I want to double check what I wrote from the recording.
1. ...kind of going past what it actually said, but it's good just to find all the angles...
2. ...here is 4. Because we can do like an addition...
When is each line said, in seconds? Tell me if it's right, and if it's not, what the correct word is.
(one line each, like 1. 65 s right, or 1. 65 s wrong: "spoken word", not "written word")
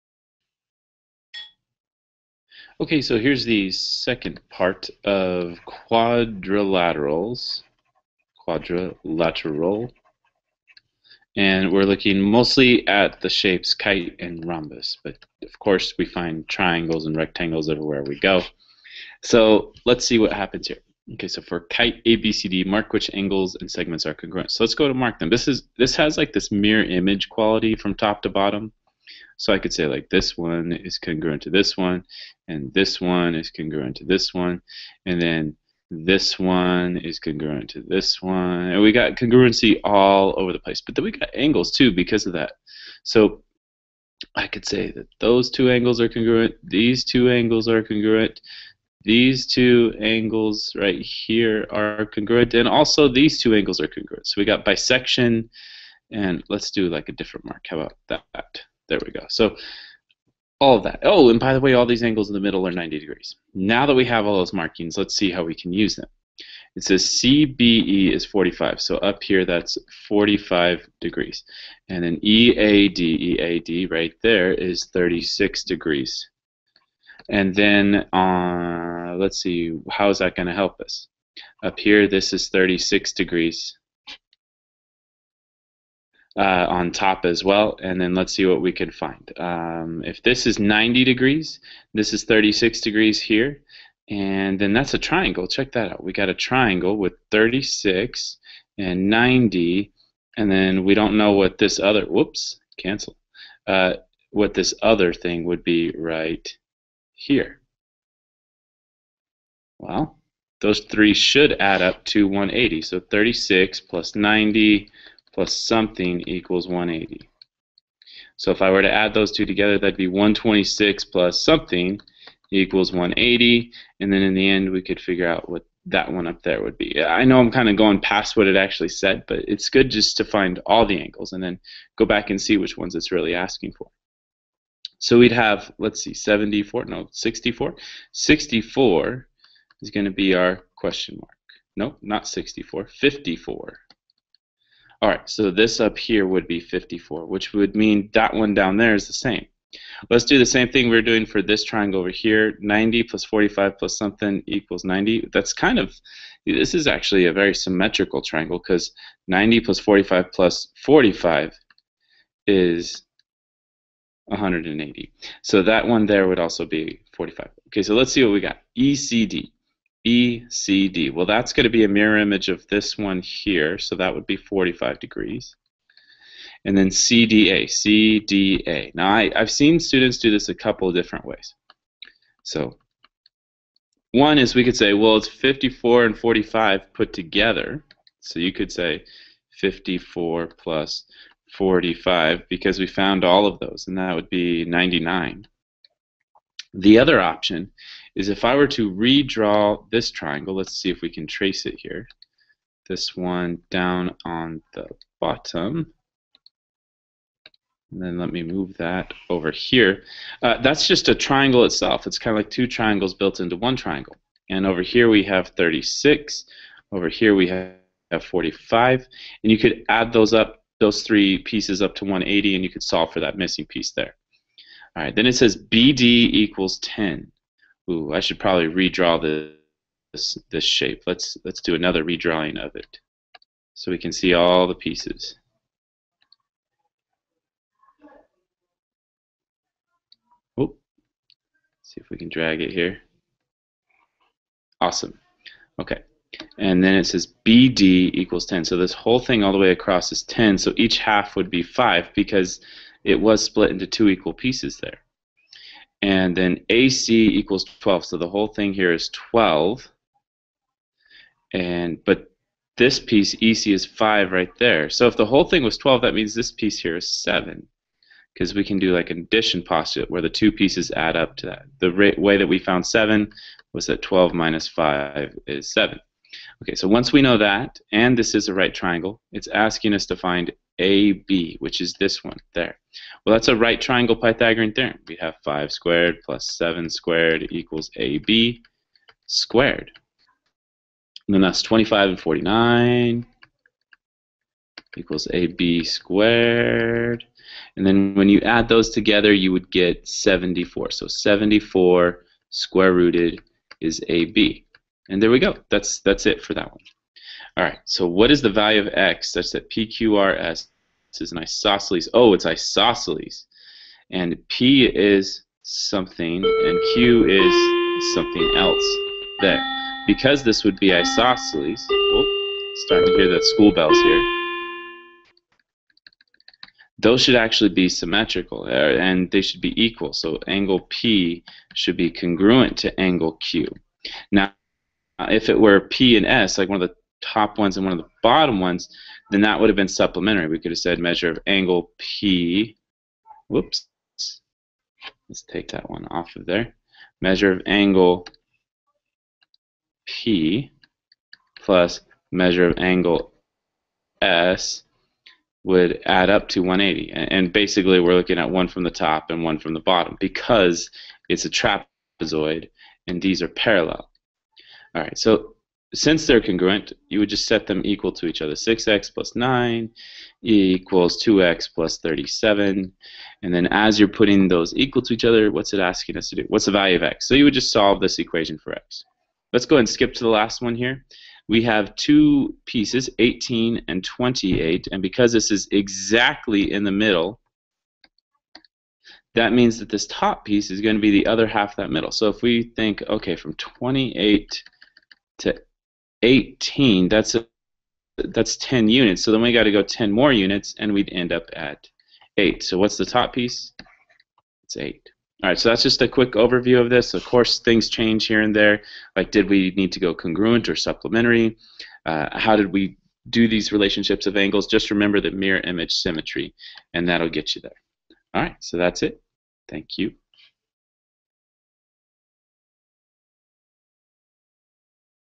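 1. 127 s right
2. 266 s wrong: "7", not "4".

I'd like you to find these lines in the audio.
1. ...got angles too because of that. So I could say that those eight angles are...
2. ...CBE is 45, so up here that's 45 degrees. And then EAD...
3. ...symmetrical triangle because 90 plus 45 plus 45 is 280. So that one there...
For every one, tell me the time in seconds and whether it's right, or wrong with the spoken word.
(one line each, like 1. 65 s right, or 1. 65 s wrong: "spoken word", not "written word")
1. 41 s wrong: "two", not "eight"
2. 67 s right
3. 157 s wrong: "180", not "280".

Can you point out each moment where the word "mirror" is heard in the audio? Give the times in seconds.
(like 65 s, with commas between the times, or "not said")
26 s, 171 s, 415 s.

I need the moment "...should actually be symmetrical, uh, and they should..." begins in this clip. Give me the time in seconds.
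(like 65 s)
327 s.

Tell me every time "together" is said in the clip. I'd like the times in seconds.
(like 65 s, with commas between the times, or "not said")
119 s, 187 s, 298 s.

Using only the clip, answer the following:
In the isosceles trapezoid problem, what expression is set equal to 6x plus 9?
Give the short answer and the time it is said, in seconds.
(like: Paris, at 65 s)
2x + 37, at 371 s.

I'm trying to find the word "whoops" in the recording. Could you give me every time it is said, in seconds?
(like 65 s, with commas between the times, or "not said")
102 s, 343 s.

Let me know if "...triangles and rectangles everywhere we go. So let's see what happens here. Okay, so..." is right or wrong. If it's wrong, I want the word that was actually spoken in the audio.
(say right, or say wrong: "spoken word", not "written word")
right.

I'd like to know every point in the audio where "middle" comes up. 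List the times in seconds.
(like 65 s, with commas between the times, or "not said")
62 s, 386 s, 391 s.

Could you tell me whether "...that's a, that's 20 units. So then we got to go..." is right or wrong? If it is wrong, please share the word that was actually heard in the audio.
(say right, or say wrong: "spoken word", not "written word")
wrong: "10", not "20".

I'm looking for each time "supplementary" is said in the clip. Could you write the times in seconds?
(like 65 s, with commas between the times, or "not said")
339 s, 410 s.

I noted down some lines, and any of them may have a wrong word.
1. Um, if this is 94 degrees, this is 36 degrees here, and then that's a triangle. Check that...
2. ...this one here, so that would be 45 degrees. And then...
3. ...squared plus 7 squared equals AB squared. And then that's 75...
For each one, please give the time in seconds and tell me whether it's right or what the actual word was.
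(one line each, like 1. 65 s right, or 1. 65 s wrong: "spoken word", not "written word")
1. 89 s wrong: "90", not "94"
2. 172 s right
3. 285 s wrong: "25", not "75".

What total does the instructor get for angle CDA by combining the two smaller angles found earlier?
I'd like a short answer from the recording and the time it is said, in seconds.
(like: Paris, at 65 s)
99, at 194 s.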